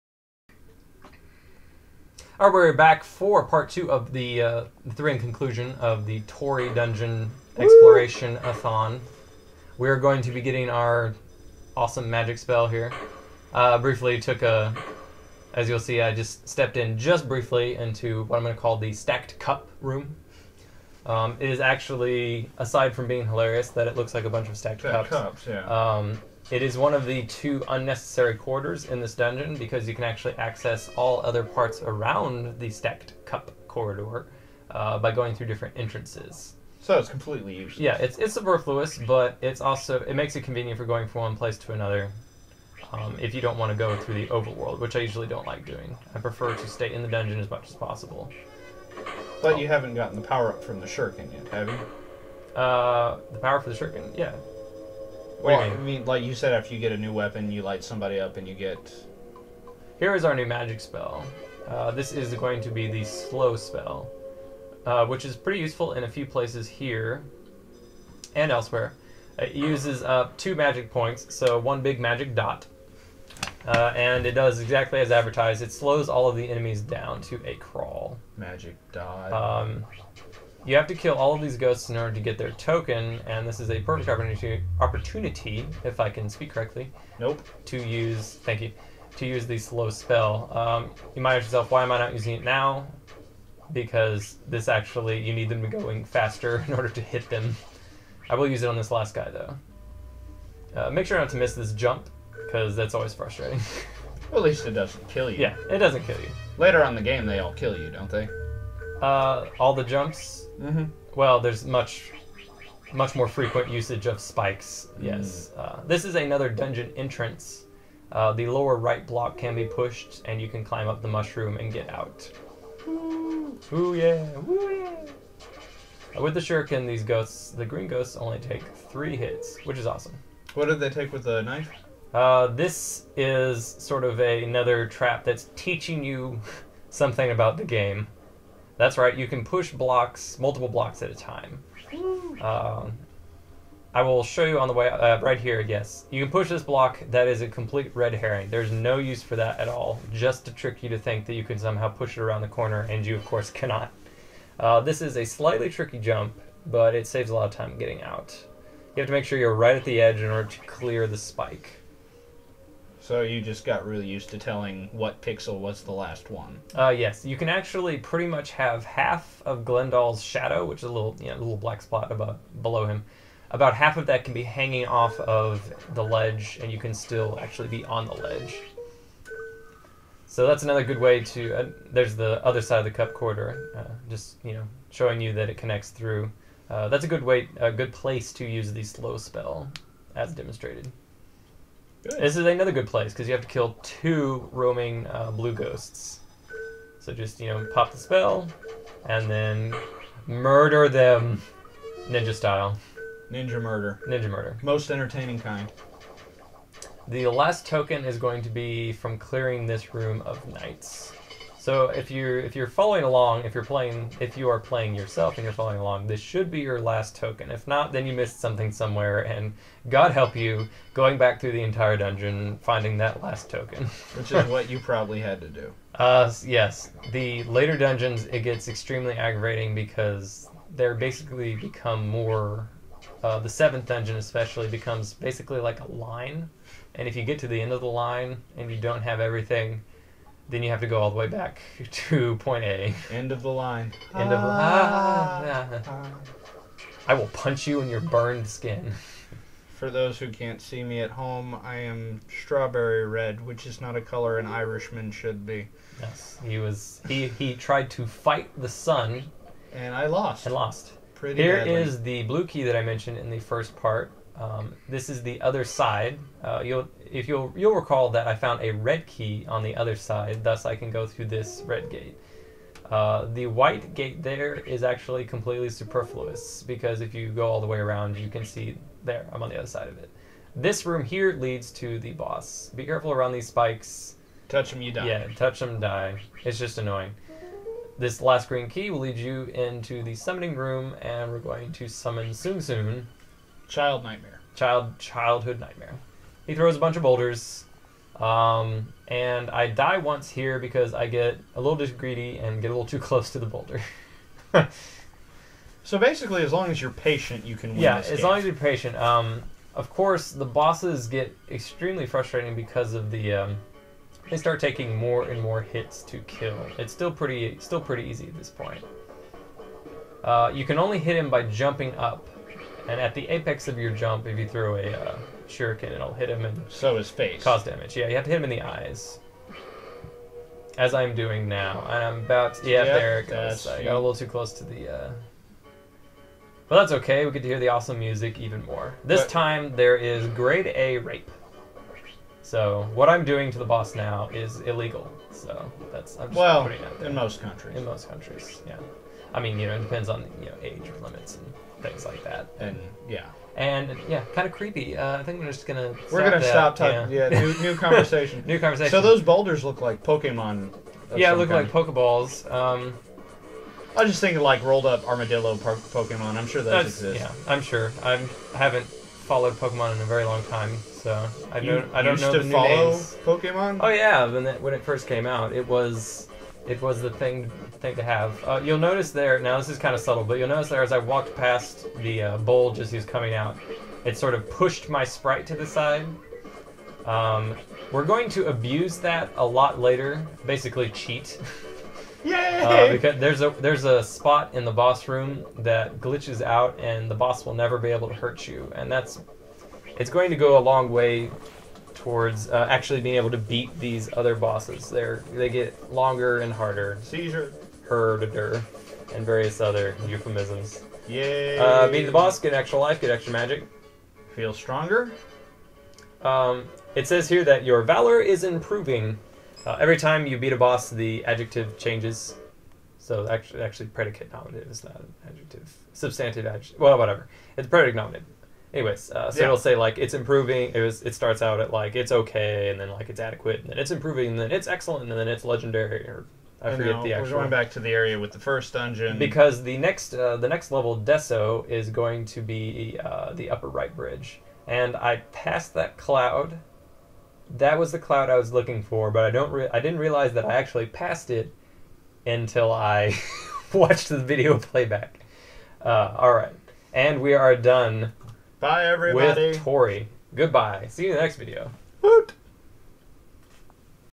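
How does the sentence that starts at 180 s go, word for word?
So that's another good way to.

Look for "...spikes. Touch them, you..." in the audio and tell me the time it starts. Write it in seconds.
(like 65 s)
283 s.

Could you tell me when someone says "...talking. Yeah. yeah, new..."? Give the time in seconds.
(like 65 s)
356 s.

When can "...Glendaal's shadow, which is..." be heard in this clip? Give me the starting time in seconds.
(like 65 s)
169 s.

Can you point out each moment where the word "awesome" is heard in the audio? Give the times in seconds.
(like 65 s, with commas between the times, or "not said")
11 s, 129 s, 337 s.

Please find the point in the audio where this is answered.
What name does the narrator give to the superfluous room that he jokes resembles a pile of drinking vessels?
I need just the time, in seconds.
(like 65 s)
18 s.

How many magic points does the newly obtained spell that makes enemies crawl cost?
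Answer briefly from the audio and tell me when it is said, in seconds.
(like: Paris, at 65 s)
2, at 70 s.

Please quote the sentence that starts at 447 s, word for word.
That was the cloud I was looking for, but I don't.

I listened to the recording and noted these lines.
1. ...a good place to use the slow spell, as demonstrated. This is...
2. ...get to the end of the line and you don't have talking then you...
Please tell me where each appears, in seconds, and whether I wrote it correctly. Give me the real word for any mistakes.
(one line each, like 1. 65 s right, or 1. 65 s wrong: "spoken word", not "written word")
1. 187 s right
2. 237 s wrong: "everything", not "talking".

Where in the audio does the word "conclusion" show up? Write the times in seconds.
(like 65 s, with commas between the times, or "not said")
5 s.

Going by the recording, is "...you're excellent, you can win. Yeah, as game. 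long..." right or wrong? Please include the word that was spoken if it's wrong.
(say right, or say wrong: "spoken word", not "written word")
wrong: "patient", not "excellent".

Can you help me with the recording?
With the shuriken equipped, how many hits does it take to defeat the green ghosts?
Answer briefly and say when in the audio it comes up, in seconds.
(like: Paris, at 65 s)
3, at 128 s.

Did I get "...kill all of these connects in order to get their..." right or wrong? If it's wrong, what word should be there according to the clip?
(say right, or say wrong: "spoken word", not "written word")
wrong: "ghosts", not "connects".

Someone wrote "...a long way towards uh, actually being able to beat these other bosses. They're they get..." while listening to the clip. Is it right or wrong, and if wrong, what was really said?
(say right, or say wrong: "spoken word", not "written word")
right.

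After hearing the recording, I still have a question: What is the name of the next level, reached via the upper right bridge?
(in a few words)
Desso.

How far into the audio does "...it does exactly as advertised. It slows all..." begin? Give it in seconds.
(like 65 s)
74 s.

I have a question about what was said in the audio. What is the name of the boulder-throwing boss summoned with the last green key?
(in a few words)
Sung Sung.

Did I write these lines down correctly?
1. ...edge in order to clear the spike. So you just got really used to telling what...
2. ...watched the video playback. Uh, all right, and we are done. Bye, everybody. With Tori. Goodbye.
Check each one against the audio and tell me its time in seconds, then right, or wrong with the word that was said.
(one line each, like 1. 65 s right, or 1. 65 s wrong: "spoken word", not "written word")
1. 160 s right
2. 453 s right.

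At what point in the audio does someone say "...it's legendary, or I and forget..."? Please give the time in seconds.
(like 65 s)
435 s.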